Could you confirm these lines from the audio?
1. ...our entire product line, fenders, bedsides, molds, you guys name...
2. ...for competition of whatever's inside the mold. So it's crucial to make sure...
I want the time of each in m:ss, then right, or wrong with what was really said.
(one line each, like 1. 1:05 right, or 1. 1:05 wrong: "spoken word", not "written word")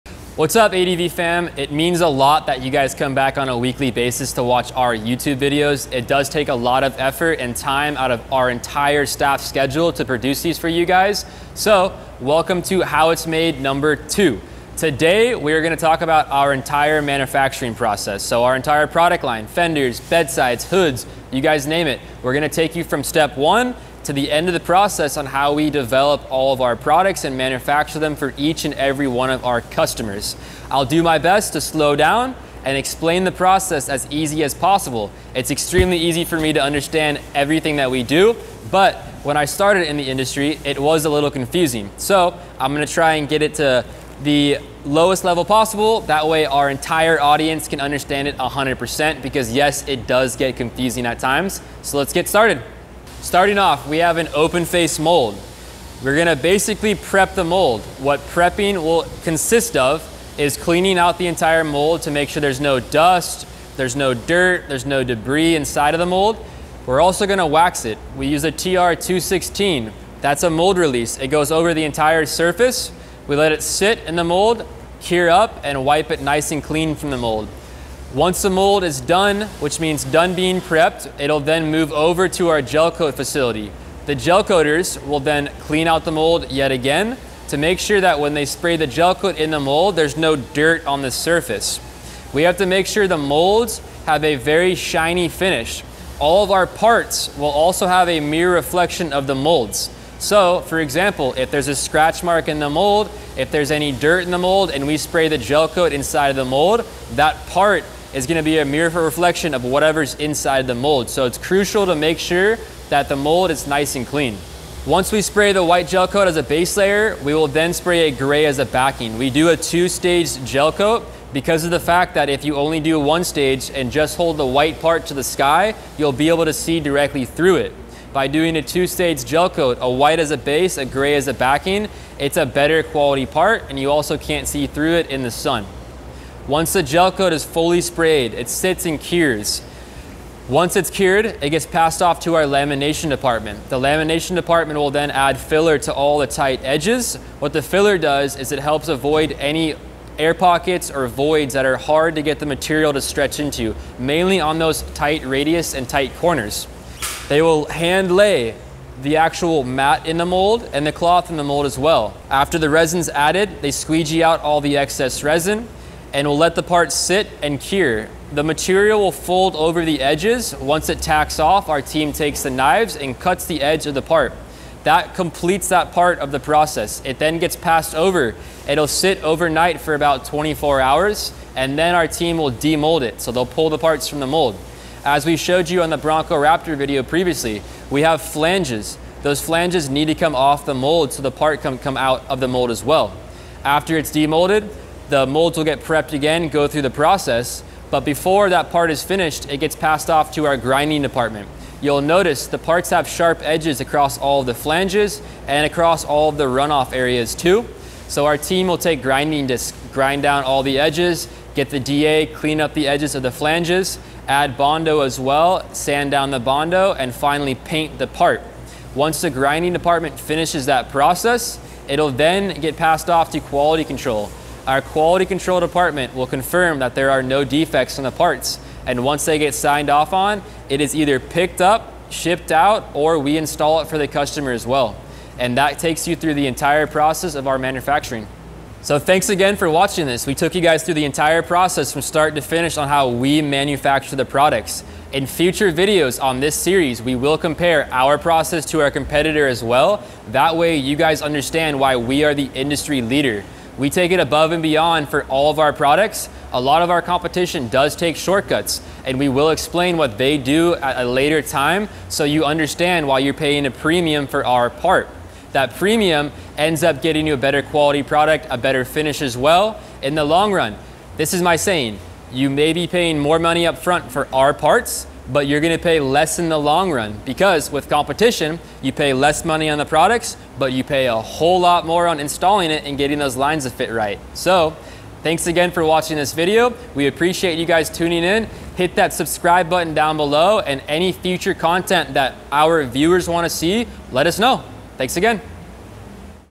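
1. 0:18 wrong: "hoods", not "molds"
2. 1:48 wrong: "reflection", not "competition".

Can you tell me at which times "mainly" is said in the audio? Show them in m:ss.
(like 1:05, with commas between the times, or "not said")
2:33.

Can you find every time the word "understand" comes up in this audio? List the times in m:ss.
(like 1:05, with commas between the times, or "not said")
0:36, 0:47, 4:11, 4:22.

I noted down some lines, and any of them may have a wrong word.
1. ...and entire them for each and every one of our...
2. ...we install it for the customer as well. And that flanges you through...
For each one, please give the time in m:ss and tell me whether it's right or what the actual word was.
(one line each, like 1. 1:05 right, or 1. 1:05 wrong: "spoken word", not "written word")
1. 0:27 wrong: "manufacture", not "entire"
2. 3:53 wrong: "takes", not "flanges".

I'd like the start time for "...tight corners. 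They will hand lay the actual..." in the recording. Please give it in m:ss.
2:35.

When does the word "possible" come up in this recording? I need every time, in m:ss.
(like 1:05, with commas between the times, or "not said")
0:34, 0:45.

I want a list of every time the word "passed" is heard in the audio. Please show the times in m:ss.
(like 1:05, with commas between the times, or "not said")
2:21, 2:57, 3:19, 3:42.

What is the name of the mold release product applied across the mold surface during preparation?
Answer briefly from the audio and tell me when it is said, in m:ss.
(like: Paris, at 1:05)
TR216, at 1:08.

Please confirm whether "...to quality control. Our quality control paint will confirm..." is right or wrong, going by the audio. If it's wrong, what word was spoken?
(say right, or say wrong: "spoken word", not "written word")
wrong: "department", not "paint".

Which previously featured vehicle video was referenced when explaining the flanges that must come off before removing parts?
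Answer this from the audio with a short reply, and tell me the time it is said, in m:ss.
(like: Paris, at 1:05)
Bronco Raptor, at 3:05.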